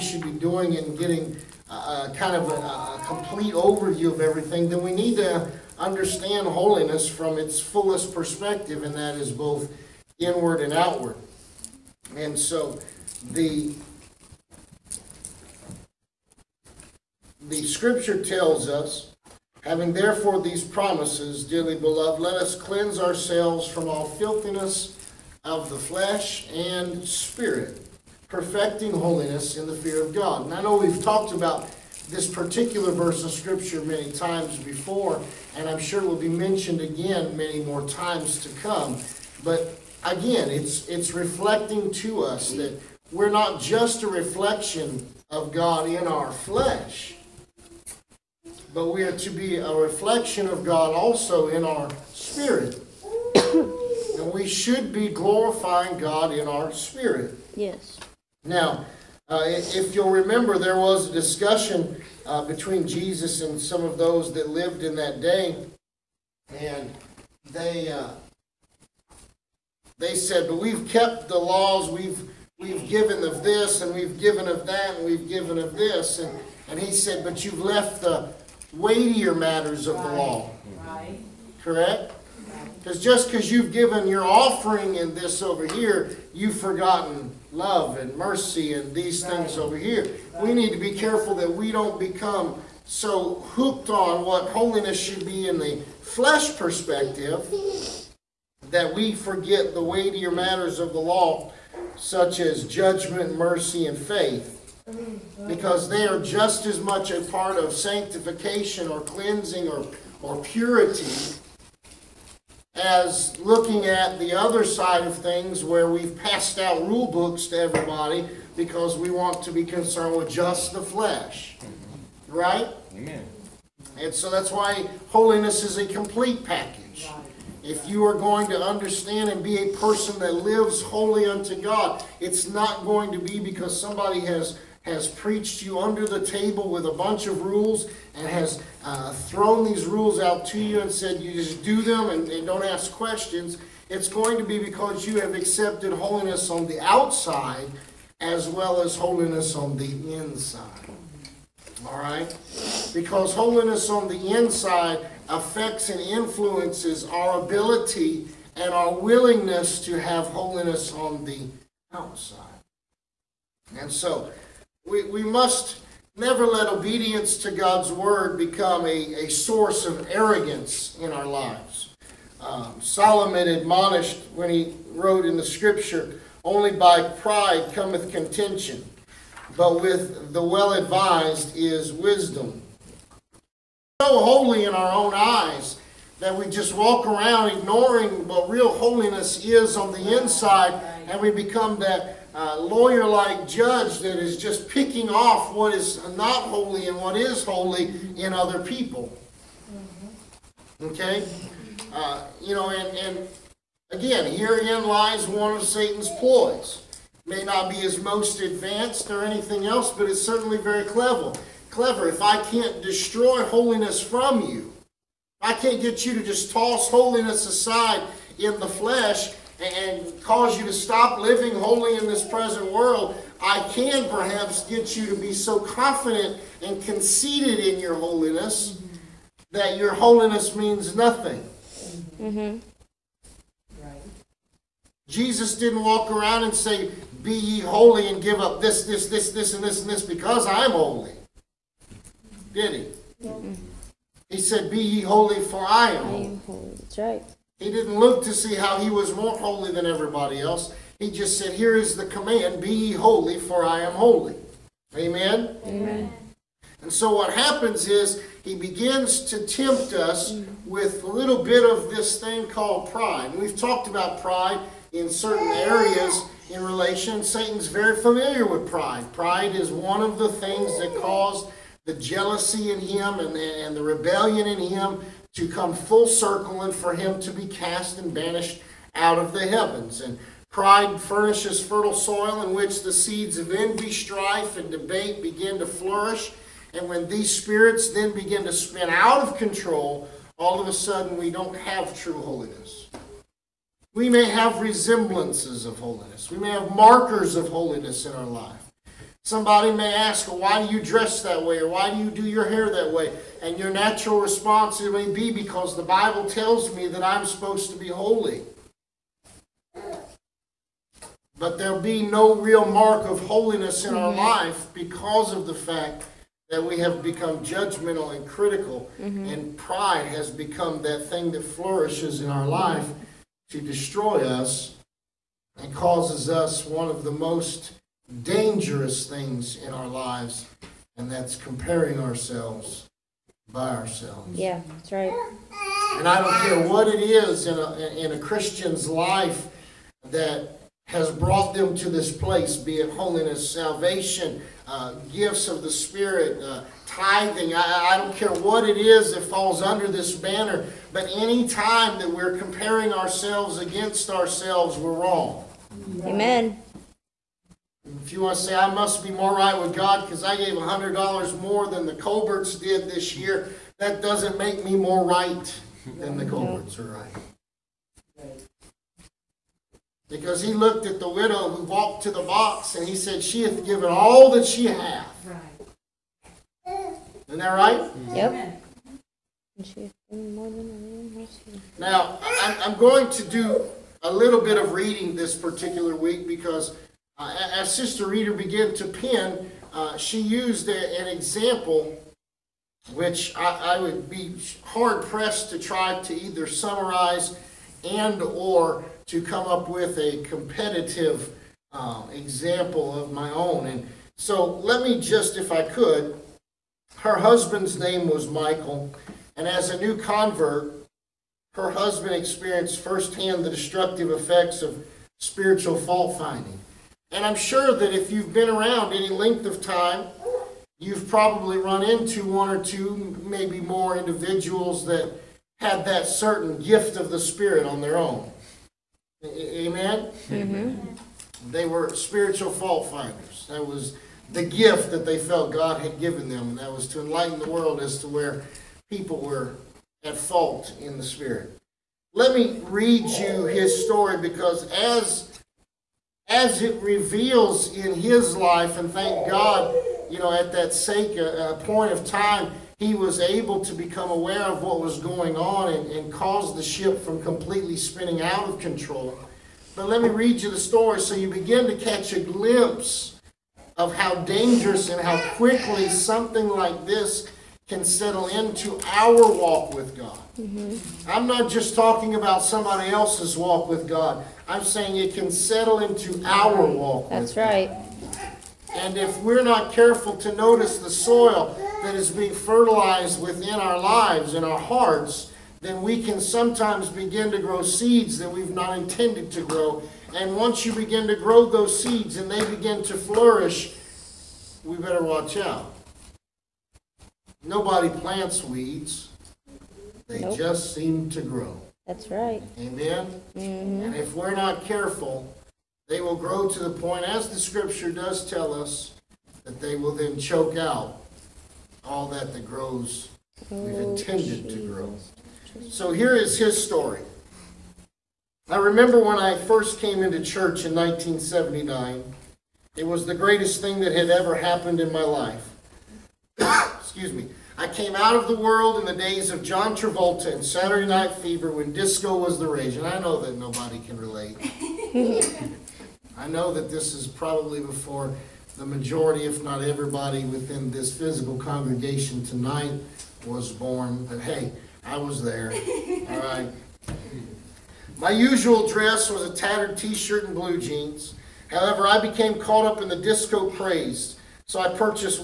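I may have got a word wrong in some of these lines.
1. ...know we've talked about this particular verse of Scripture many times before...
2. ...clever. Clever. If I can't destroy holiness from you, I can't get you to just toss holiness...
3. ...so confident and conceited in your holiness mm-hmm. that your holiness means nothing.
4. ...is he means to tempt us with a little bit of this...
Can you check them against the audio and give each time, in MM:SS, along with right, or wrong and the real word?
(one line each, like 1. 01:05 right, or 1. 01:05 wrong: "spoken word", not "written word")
1. 00:30 right
2. 03:30 right
3. 03:45 right
4. 04:17 wrong: "begins", not "means".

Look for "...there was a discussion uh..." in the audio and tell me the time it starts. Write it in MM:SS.
01:00.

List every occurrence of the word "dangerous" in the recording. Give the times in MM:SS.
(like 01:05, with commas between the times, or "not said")
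05:28, 07:44.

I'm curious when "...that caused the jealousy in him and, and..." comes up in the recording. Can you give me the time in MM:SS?
04:30.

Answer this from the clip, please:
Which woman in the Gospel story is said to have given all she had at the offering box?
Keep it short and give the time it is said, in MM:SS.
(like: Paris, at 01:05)
the widow, at 06:11.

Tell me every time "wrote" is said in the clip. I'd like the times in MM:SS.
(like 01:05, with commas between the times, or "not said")
02:54.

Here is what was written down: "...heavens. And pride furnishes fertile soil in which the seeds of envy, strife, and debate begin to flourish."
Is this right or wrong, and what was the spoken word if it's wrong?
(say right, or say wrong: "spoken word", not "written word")
right.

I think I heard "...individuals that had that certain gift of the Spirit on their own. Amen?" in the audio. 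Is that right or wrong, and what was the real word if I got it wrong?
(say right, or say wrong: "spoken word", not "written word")
right.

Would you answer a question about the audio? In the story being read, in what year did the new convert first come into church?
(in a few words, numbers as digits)
1979.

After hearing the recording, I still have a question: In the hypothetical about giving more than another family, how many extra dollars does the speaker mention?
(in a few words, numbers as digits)
$100.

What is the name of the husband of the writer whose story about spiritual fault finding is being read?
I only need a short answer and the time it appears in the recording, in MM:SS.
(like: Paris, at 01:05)
Michael, at 06:48.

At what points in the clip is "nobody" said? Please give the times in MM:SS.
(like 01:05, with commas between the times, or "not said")
08:17, 08:53.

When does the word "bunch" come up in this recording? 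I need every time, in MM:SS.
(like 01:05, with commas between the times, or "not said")
02:16.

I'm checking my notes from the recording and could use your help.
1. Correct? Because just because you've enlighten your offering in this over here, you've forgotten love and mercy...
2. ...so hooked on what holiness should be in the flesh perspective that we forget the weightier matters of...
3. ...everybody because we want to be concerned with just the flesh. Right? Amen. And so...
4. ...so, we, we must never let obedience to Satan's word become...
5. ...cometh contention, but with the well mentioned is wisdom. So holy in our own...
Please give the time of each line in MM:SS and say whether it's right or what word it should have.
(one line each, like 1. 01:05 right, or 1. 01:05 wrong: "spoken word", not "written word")
1. 01:21 wrong: "given", not "enlighten"
2. 01:32 right
3. 01:57 right
4. 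02:43 wrong: "God", not "Satan"
5. 02:57 wrong: "advised", not "mentioned".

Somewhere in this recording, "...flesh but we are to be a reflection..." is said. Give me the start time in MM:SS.
00:46.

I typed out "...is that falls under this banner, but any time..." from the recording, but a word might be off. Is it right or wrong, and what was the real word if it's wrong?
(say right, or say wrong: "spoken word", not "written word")
right.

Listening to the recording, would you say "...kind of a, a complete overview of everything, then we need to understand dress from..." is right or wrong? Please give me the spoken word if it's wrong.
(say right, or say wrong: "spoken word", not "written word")
wrong: "holiness", not "dress".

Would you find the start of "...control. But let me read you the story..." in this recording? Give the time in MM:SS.
07:38.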